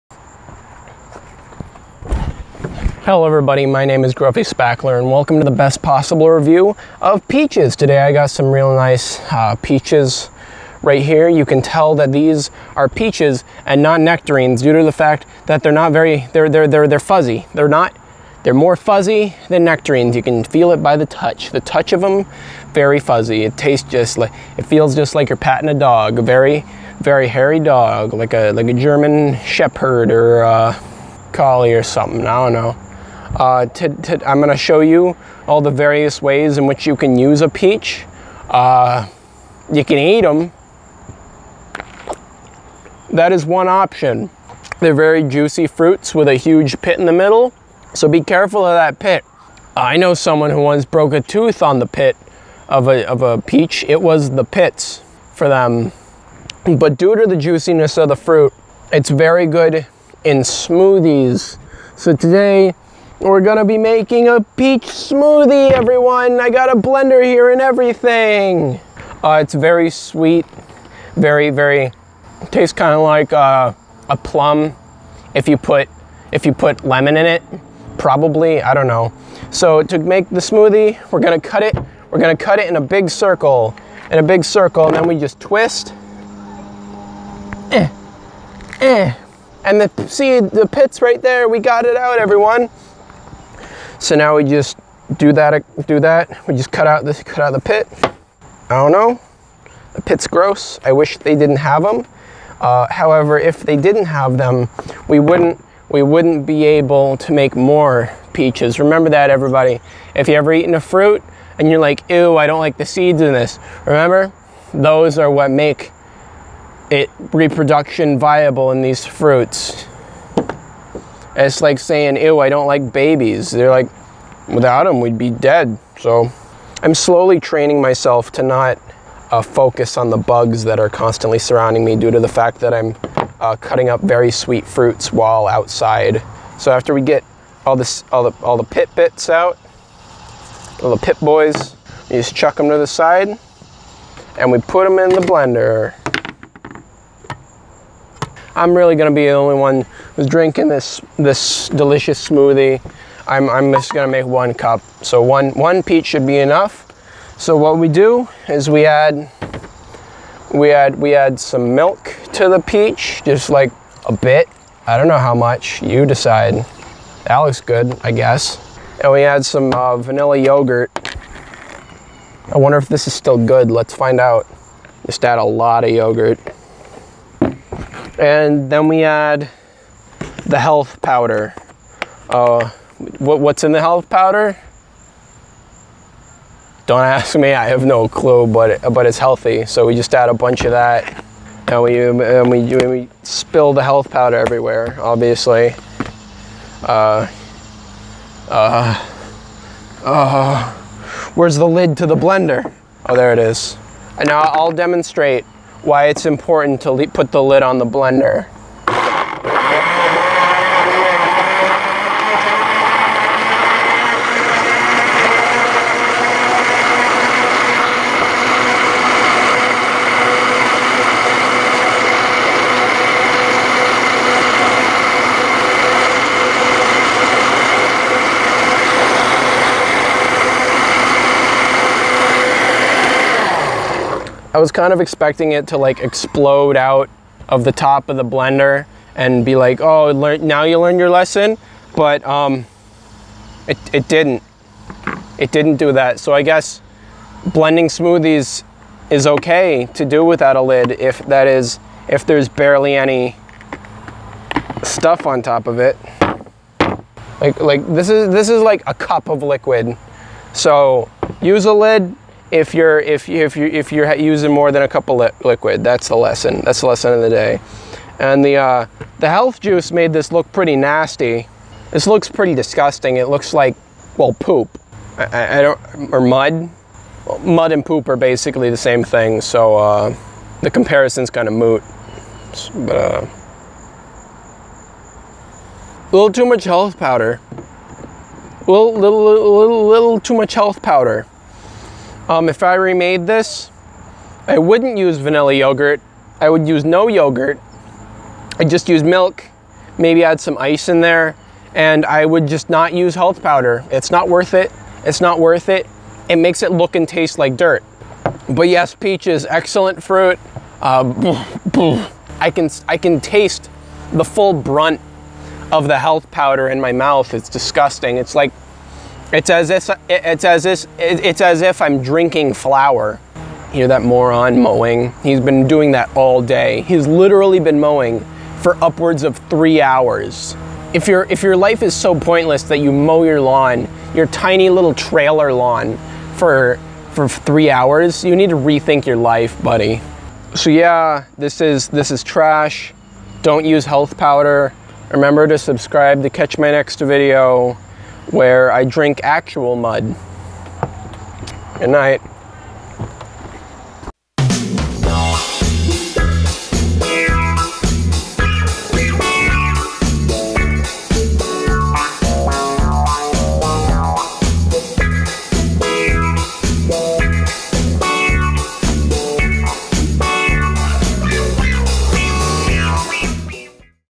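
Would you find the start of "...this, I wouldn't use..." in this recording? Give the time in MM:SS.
04:53.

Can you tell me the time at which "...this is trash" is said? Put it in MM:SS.
05:41.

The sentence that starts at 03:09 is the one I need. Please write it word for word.
So we just add a bunch of that and we, um, and we, we spill the health powder everywhere, obviously.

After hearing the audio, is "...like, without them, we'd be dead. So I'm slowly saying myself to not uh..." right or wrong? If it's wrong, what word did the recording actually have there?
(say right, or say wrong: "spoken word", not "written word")
wrong: "training", not "saying".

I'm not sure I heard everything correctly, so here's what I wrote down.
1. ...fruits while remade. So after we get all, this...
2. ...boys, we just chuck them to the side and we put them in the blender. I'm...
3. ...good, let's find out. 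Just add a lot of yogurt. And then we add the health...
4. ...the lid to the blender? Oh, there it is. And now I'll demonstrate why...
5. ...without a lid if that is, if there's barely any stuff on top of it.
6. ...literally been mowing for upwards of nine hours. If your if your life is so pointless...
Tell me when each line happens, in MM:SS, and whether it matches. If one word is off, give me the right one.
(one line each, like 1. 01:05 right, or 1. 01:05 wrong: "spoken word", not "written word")
1. 02:14 wrong: "outside", not "remade"
2. 02:21 right
3. 02:53 right
4. 03:21 right
5. 04:10 right
6. 05:27 wrong: "three", not "nine".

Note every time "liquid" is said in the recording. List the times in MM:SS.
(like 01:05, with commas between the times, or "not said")
04:19, 04:25.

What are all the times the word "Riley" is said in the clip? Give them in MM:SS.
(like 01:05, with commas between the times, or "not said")
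not said.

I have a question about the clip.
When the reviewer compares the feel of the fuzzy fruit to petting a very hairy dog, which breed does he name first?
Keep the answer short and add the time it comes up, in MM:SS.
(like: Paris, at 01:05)
German shepherd, at 00:28.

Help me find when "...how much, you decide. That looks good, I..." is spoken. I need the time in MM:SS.
02:45.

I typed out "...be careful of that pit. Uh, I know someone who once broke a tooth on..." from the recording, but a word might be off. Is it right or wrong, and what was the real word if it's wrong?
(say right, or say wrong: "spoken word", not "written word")
right.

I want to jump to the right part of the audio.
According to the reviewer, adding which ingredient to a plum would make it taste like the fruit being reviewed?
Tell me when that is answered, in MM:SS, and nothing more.
01:16.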